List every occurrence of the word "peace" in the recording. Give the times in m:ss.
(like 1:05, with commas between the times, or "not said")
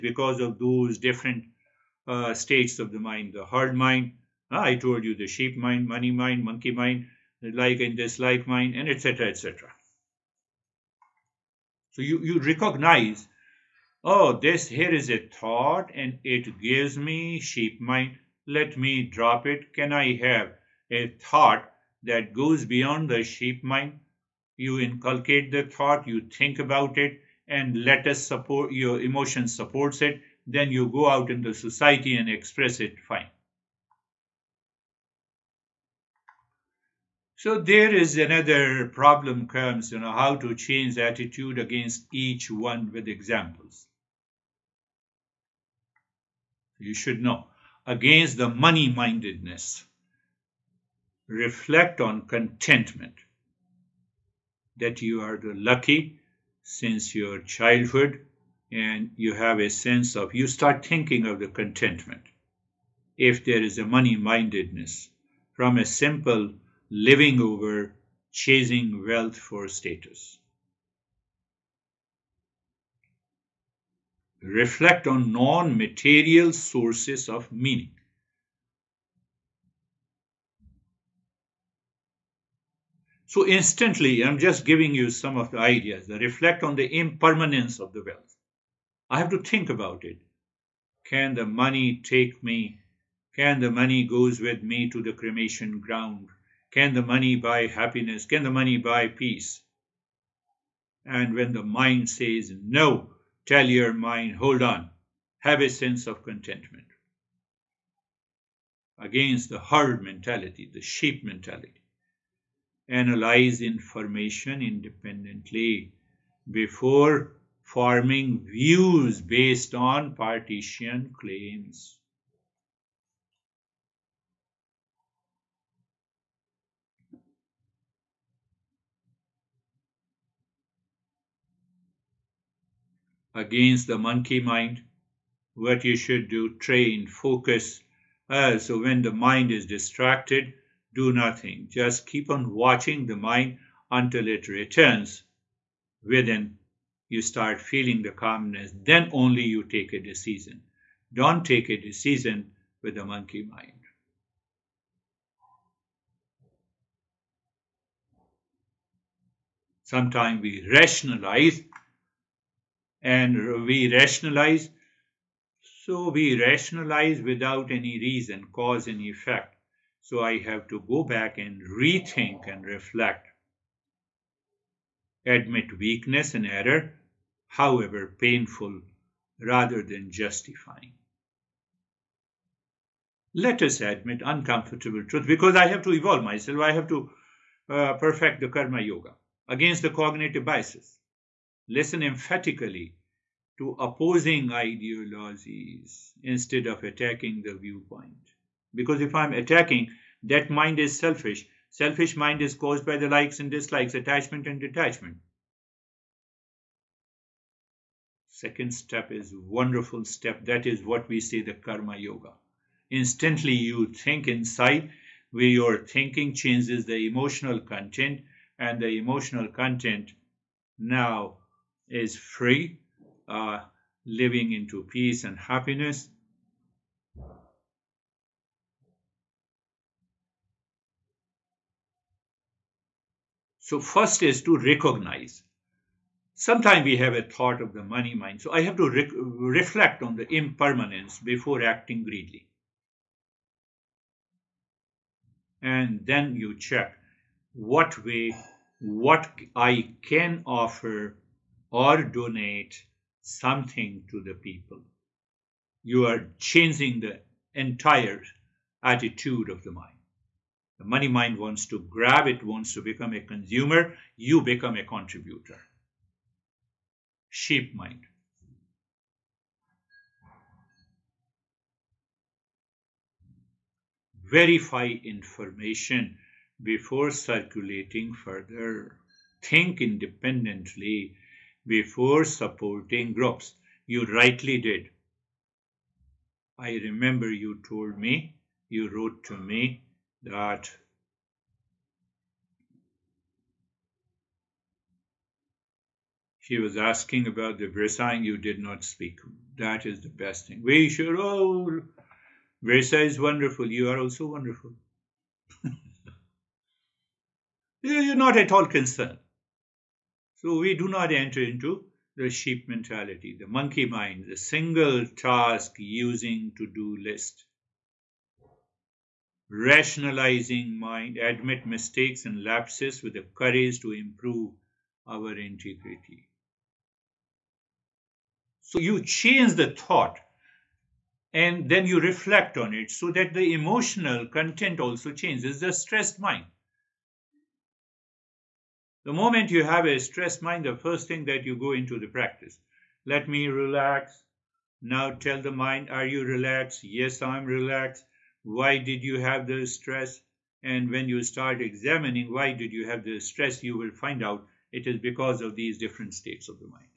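1:39, 3:44.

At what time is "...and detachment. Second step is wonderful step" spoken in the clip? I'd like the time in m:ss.
3:24.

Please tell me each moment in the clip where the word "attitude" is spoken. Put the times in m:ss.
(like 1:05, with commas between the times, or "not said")
0:40, 4:18.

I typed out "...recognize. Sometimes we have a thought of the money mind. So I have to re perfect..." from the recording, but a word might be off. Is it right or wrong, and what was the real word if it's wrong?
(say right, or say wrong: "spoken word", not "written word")
wrong: "reflect", not "perfect".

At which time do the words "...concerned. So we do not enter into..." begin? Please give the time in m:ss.
5:08.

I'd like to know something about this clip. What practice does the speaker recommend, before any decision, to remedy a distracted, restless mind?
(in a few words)
train focus.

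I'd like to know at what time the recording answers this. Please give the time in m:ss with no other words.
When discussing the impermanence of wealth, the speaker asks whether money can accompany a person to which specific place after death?
1:35.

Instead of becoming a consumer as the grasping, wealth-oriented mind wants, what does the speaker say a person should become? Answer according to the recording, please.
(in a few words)
a contributor.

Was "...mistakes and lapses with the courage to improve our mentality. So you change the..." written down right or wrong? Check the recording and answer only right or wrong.
wrong.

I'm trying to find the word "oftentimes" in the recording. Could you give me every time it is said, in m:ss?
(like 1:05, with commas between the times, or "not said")
not said.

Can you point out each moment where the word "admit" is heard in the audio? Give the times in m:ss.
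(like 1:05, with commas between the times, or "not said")
2:55, 3:03, 5:21.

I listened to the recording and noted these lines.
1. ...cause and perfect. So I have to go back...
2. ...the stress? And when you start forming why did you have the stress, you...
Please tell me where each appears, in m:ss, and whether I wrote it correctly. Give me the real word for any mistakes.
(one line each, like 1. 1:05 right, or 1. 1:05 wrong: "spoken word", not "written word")
1. 2:48 wrong: "effect", not "perfect"
2. 5:49 wrong: "examining", not "forming".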